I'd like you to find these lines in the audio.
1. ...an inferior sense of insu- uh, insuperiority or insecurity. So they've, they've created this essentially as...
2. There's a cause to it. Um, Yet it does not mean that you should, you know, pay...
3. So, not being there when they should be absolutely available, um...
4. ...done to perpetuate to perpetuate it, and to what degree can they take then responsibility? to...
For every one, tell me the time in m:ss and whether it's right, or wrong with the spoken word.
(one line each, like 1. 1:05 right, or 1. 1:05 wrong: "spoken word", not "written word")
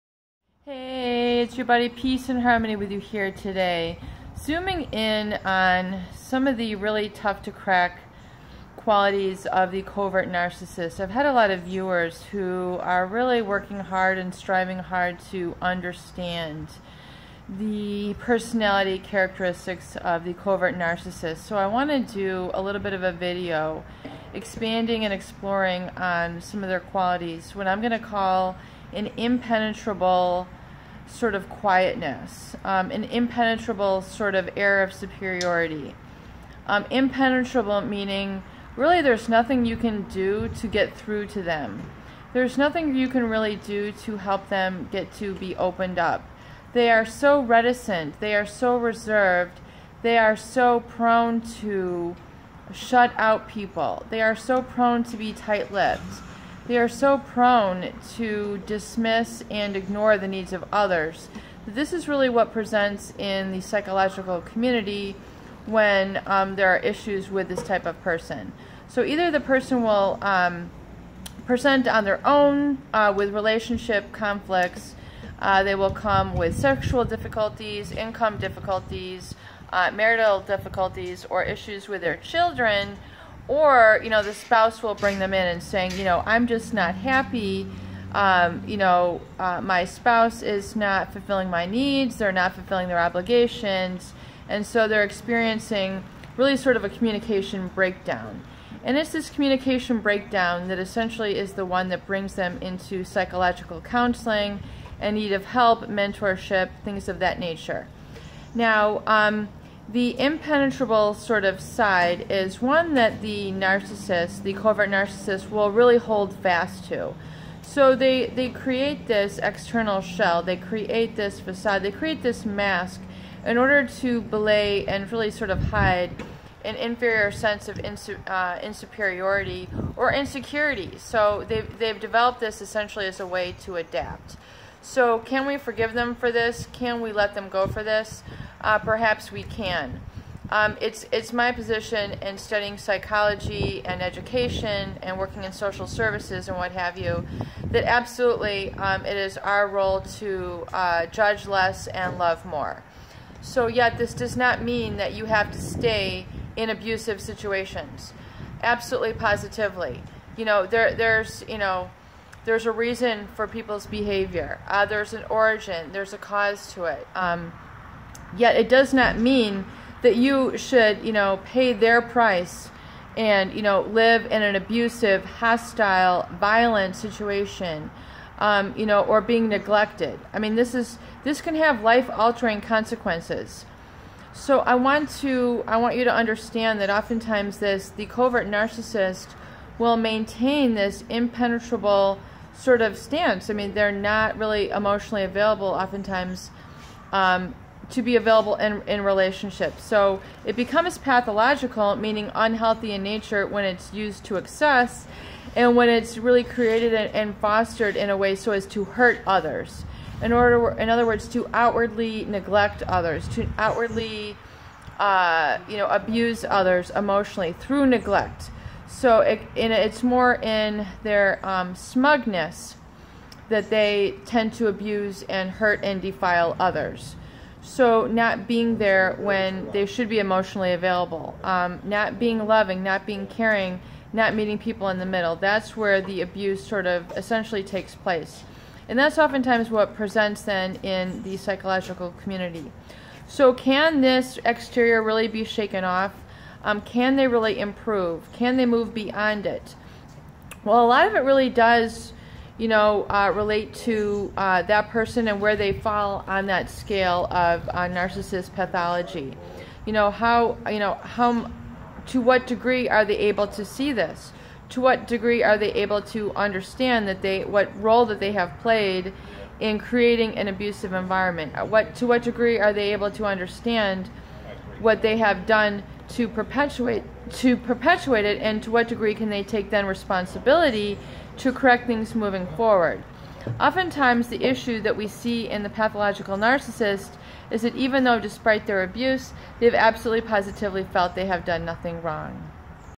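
1. 2:06 wrong: "developed", not "created"
2. 2:45 right
3. 3:47 wrong: "emotionally", not "absolutely"
4. 4:35 right.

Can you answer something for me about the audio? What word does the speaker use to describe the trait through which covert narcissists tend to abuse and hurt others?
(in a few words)
Smugness.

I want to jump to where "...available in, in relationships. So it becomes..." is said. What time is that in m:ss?
3:18.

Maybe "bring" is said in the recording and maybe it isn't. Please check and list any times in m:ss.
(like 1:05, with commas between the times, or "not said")
1:24, 1:42.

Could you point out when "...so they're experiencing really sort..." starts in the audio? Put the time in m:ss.
1:34.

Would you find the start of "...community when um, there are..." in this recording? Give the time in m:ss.
1:04.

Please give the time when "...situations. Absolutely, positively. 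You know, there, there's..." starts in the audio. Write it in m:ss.
2:37.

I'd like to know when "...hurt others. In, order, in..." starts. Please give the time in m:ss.
3:28.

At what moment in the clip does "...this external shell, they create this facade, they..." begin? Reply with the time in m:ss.
1:59.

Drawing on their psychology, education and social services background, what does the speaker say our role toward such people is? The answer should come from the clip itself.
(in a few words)
Judge less and love more.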